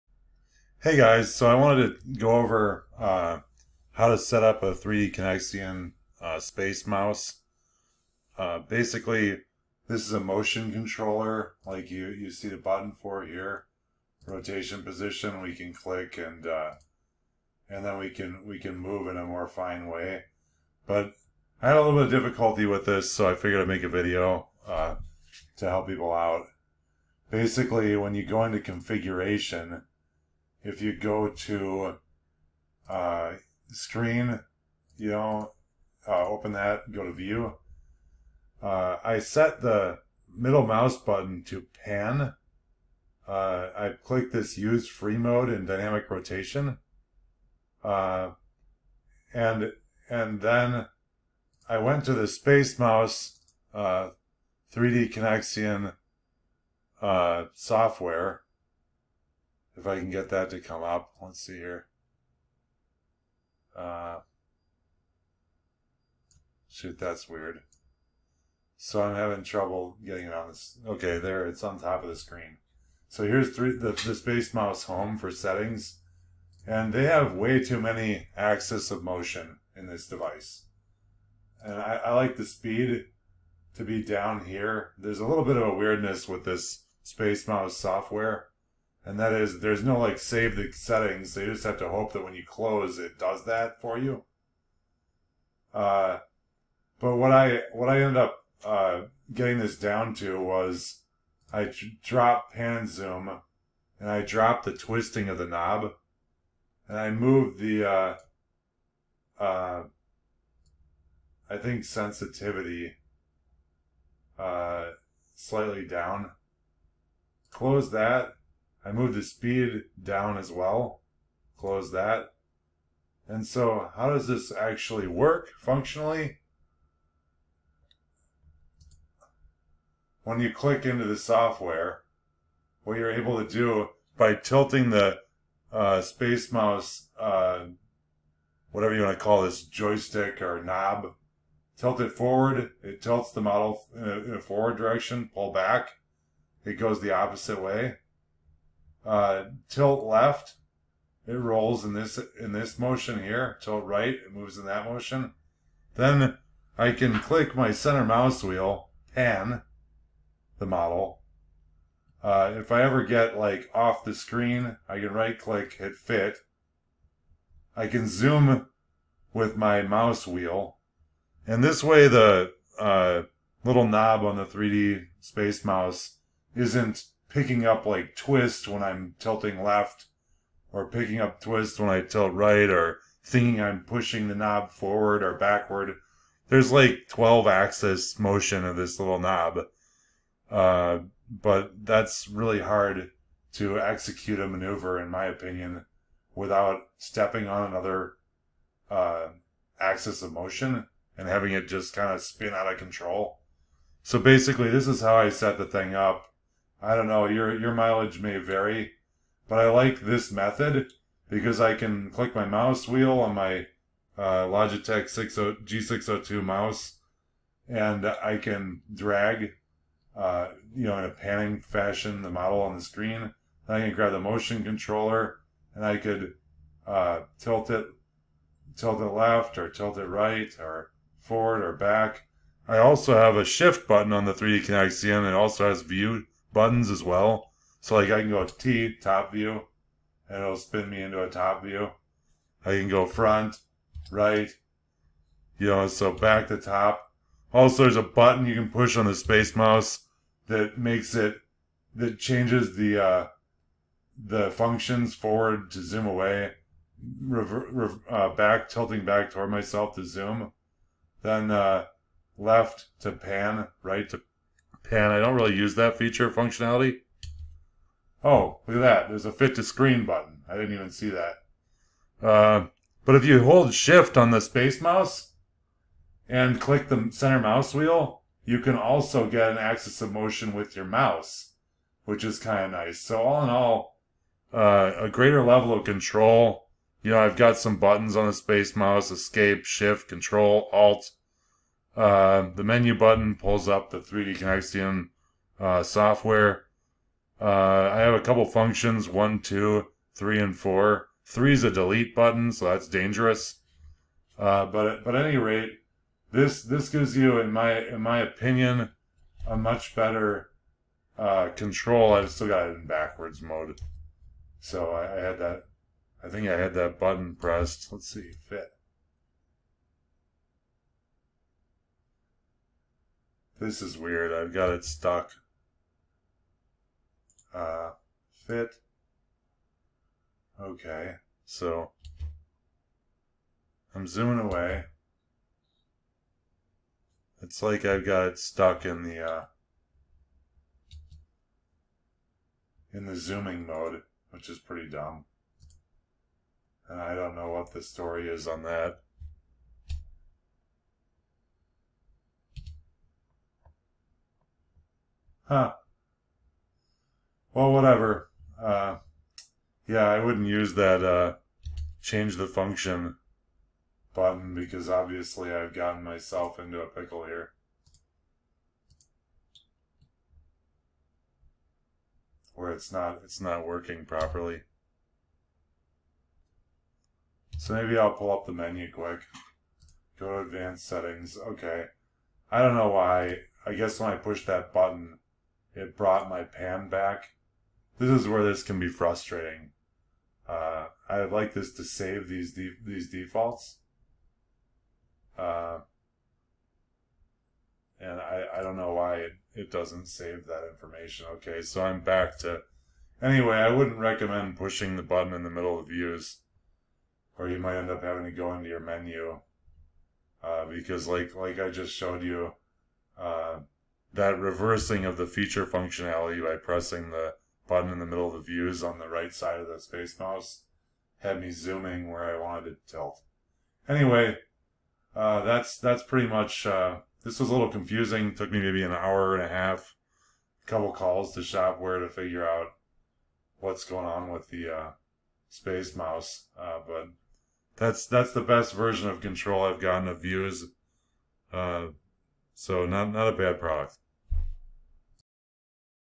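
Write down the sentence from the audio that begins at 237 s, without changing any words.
So like I can go T top view, and it'll spin me into a top view.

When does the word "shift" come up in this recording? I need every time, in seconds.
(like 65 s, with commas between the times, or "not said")
233 s, 273 s, 289 s.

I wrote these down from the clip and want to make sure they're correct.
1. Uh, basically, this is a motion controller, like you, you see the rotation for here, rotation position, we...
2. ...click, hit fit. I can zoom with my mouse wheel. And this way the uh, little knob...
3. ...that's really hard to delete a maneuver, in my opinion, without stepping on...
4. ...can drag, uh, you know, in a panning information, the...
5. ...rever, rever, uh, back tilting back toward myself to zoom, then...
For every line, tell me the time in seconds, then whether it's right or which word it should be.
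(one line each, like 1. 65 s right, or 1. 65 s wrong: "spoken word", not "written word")
1. 8 s wrong: "button", not "rotation"
2. 165 s right
3. 191 s wrong: "execute", not "delete"
4. 218 s wrong: "fashion", not "information"
5. 257 s right.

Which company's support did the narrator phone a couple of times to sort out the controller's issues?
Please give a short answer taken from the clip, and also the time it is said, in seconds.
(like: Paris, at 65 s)
Shopware, at 431 s.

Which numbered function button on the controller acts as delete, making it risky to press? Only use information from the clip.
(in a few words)
3.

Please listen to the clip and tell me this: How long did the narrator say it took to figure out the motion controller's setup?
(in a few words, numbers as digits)
an hour and a half.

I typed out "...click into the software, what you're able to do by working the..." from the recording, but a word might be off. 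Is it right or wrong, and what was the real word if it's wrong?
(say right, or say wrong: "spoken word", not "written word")
wrong: "tilting", not "working".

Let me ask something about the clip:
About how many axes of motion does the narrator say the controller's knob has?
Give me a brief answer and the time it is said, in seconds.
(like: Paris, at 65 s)
12, at 187 s.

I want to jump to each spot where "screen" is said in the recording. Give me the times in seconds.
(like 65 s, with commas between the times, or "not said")
33 s, 72 s, 164 s, 222 s, 269 s.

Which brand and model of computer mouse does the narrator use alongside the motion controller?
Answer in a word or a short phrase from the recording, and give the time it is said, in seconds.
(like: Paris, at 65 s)
Logitech G602, at 214 s.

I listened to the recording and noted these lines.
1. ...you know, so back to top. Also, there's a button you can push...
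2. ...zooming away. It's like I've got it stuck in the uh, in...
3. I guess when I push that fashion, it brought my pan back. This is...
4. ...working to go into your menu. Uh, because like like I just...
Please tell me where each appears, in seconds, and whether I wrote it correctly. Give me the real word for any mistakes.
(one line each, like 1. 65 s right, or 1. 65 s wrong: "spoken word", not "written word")
1. 245 s right
2. 334 s right
3. 383 s wrong: "button", not "fashion"
4. 408 s wrong: "having", not "working".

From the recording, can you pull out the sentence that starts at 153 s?
Tilt right, it moves in that motion.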